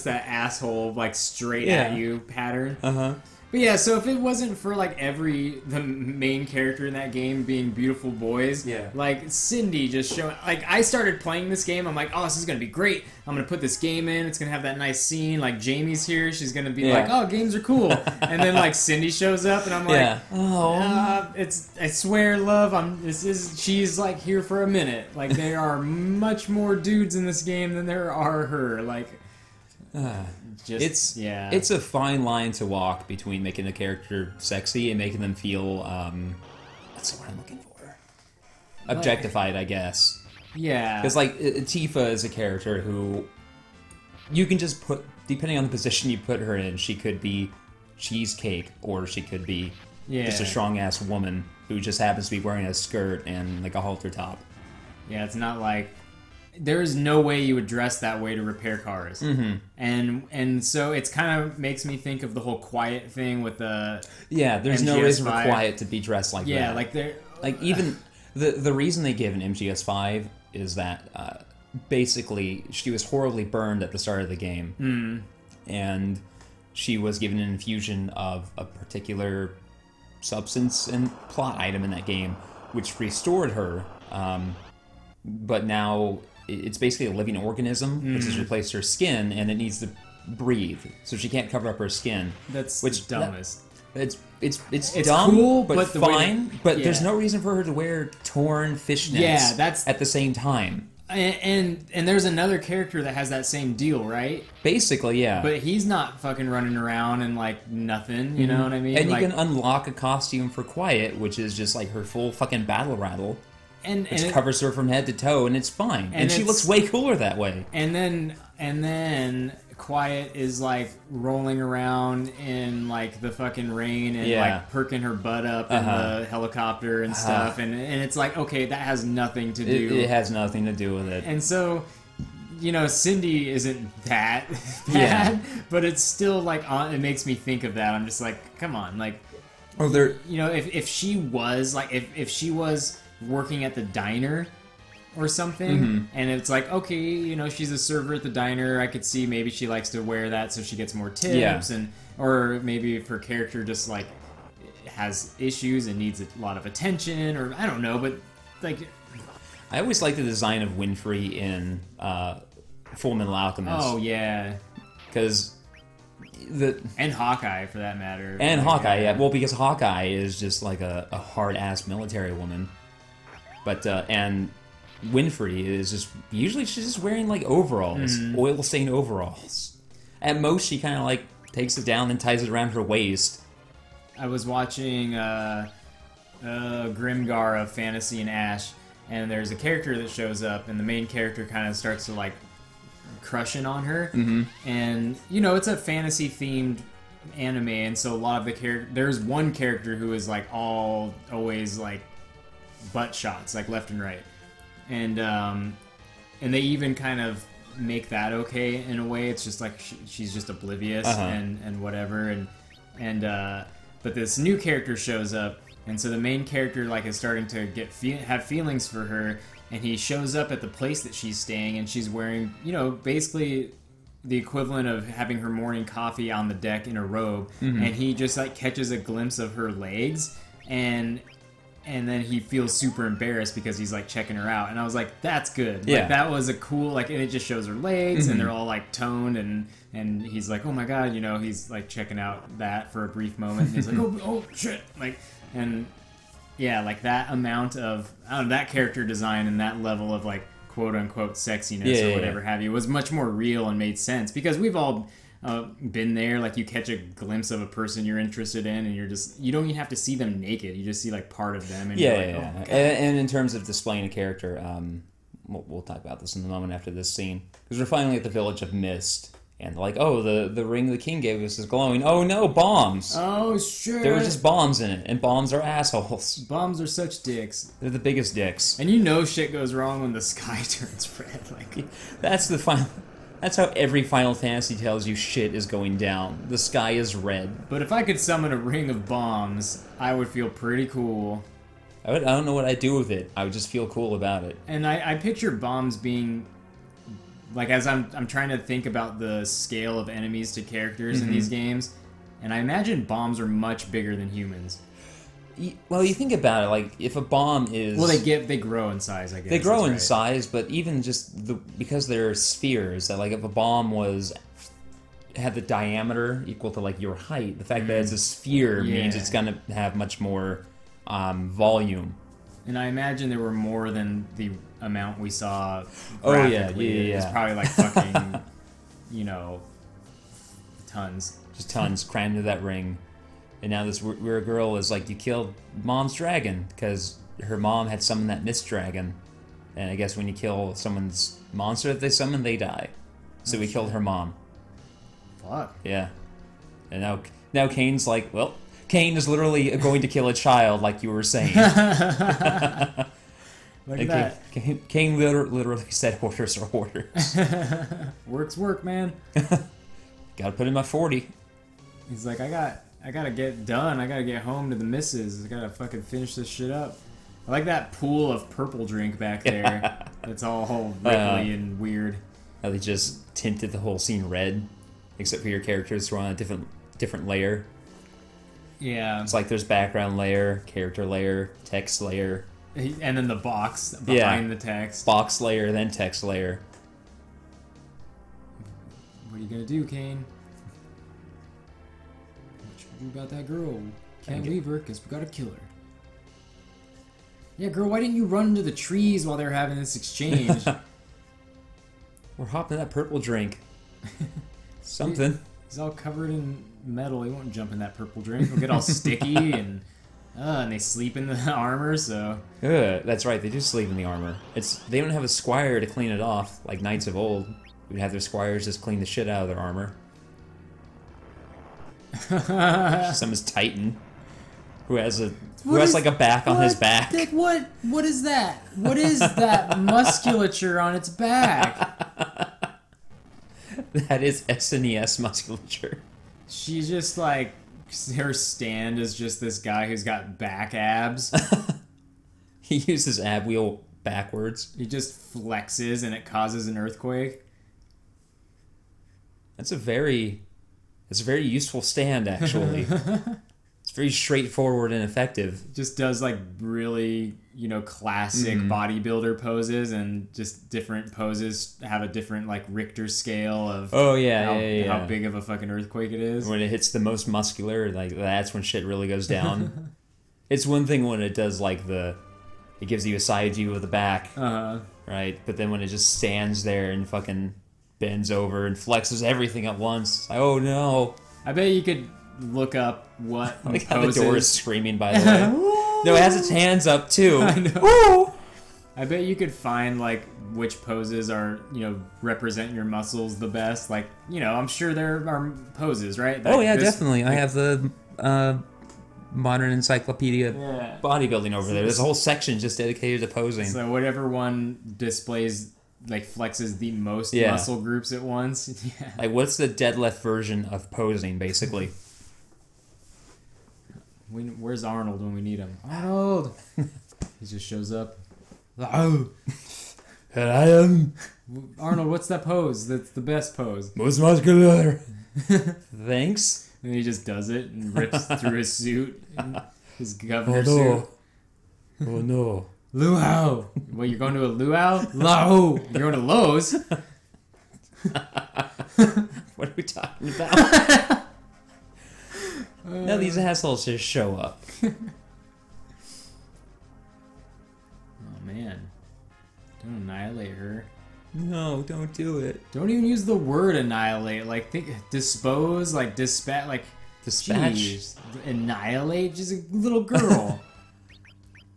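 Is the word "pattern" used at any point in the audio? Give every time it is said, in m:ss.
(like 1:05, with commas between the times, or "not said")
0:02.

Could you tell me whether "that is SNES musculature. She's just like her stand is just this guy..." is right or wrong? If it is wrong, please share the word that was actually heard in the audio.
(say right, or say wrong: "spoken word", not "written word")
right.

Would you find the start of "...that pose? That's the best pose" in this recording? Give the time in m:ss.
8:42.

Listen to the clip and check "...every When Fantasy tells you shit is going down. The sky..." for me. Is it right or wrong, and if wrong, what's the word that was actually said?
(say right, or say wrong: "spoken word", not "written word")
wrong: "Final", not "When".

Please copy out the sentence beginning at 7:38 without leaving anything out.
bodybuilder poses and just different poses have a different like Richter scale of oh yeah how, yeah, yeah.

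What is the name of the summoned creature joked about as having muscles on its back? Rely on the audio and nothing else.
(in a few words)
Titan.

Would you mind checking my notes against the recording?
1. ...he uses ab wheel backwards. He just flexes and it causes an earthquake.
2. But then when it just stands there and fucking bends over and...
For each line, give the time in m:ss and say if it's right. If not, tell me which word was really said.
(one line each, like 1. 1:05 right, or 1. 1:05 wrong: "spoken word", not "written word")
1. 7:22 right
2. 7:55 right.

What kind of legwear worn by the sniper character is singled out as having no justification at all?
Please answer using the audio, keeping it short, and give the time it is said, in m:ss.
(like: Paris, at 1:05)
Torn fishnets, at 1:38.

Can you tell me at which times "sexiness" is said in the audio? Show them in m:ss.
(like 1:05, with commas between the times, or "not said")
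4:11.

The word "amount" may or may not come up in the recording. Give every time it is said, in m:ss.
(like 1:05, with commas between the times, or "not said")
4:07, 5:24.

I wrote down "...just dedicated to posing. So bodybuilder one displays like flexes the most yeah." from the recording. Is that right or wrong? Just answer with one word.
wrong.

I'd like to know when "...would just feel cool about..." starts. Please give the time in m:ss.
4:53.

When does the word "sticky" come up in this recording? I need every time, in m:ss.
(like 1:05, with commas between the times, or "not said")
6:48.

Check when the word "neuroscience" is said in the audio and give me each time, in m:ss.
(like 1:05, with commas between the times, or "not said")
not said.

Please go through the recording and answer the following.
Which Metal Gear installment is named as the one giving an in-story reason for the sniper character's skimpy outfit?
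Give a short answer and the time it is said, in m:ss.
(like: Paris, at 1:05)
MGS5, at 1:04.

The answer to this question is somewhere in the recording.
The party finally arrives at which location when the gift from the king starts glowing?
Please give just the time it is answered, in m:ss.
4:28.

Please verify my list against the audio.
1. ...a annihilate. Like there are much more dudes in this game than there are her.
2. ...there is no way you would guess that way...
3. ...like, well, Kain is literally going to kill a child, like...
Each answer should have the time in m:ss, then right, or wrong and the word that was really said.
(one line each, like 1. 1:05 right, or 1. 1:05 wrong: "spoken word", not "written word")
1. 0:24 wrong: "minute", not "annihilate"
2. 0:56 wrong: "dress", not "guess"
3. 5:48 right.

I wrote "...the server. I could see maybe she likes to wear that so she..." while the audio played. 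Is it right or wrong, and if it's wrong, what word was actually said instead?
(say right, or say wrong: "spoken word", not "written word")
wrong: "diner", not "server".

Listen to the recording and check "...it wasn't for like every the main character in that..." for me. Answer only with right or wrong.
right.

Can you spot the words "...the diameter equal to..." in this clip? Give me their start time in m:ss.
5:15.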